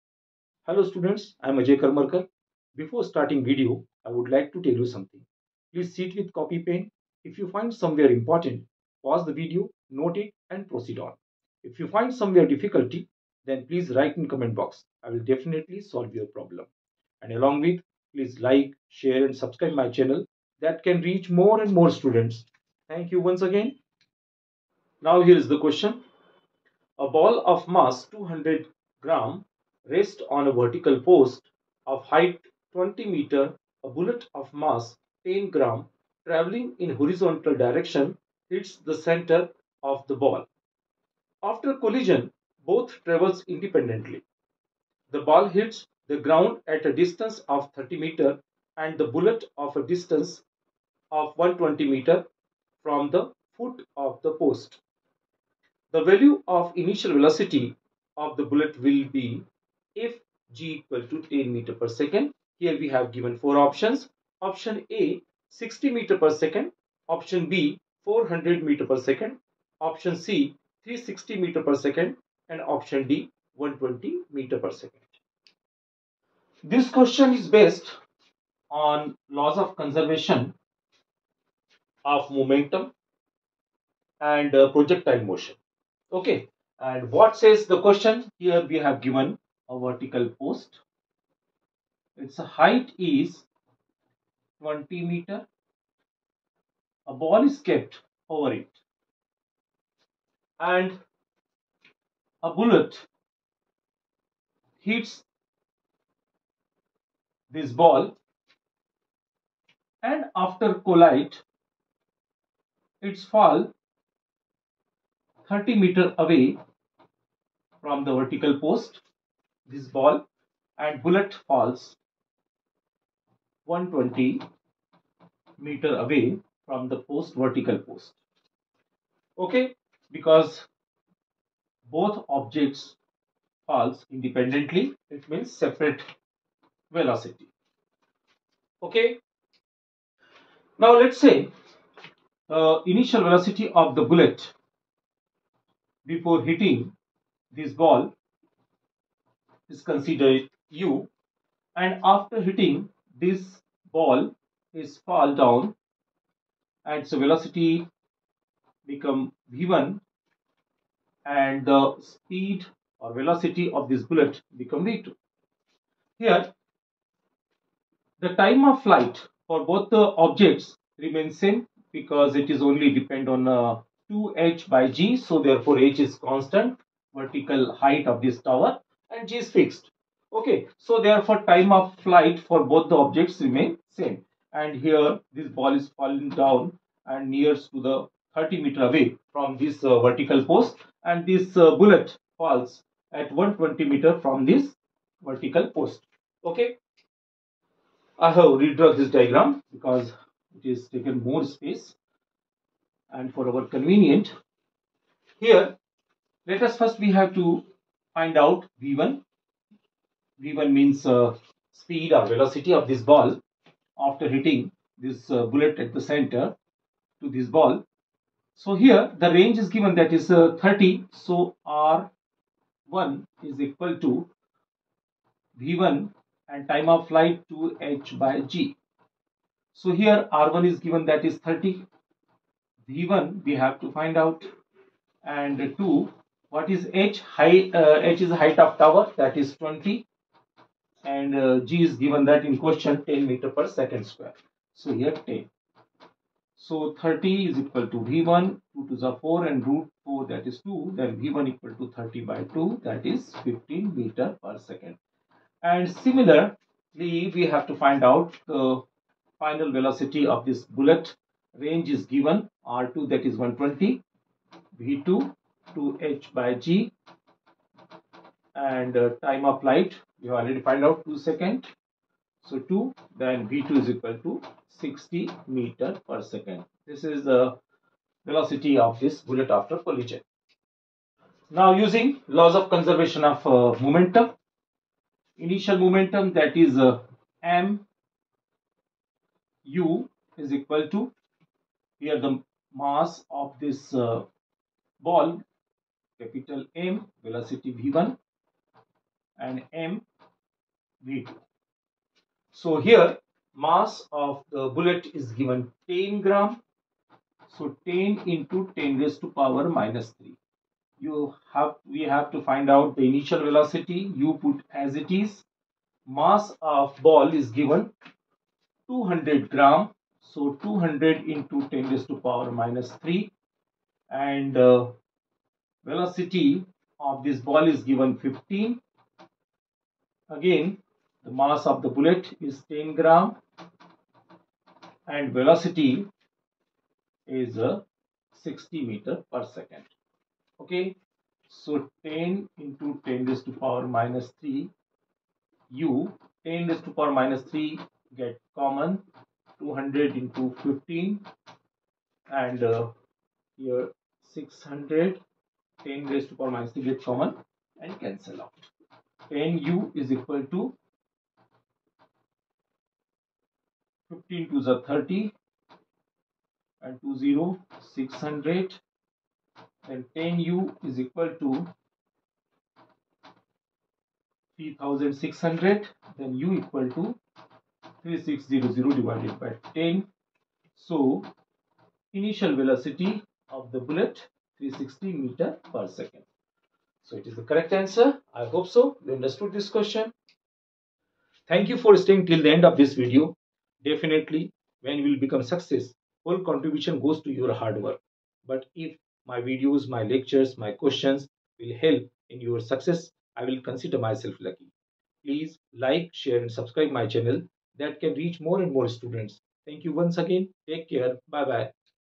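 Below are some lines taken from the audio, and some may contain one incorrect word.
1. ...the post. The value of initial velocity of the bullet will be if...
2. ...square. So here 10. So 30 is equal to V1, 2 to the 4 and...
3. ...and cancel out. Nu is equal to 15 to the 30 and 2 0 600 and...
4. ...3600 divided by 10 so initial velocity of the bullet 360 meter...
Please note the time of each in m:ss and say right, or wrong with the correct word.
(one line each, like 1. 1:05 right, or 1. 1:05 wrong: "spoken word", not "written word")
1. 0:54 right
2. 4:04 right
3. 5:57 right
4. 6:17 right.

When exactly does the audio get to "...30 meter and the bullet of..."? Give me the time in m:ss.
0:47.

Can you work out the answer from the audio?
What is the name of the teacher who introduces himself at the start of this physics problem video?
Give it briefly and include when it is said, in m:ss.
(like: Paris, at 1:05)
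Ajay Karmarkar, at 0:01.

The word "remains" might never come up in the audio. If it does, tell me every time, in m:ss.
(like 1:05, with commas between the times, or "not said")
2:51, 3:03.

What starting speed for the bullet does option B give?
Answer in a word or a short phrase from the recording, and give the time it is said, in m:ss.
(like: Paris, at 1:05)
400 m/s, at 1:08.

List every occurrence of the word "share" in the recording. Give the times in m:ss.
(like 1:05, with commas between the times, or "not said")
0:18, 6:46.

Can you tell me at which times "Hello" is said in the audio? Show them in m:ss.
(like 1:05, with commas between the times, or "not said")
0:00.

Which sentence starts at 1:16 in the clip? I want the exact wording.
This question is based on laws of conservation of momentum and uh, projectile motion.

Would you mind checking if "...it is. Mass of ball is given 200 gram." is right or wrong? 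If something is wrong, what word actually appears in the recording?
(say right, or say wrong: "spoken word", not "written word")
right.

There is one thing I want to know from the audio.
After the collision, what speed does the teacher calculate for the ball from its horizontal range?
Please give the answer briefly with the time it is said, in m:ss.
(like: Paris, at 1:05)
15 m/s, at 4:13.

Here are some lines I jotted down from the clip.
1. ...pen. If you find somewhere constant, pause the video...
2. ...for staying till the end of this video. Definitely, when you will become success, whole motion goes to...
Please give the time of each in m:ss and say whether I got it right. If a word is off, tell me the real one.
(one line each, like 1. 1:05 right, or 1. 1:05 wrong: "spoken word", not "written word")
1. 0:06 wrong: "important", not "constant"
2. 6:31 wrong: "contribution", not "motion".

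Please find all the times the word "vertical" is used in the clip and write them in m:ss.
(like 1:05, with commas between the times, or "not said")
0:30, 1:29, 1:58, 2:07, 2:57, 3:09, 3:15.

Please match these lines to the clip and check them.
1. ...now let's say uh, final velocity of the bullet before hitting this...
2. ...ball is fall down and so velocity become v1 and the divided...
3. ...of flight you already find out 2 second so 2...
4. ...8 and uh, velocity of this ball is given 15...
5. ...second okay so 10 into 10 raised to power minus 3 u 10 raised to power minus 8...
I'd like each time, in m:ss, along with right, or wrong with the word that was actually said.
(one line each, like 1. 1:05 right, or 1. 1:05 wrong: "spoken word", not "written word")
1. 2:20 wrong: "initial", not "final"
2. 2:33 wrong: "speed", not "divided"
3. 4:29 right
4. 5:22 wrong: "3", not "8"
5. 5:39 wrong: "3", not "8".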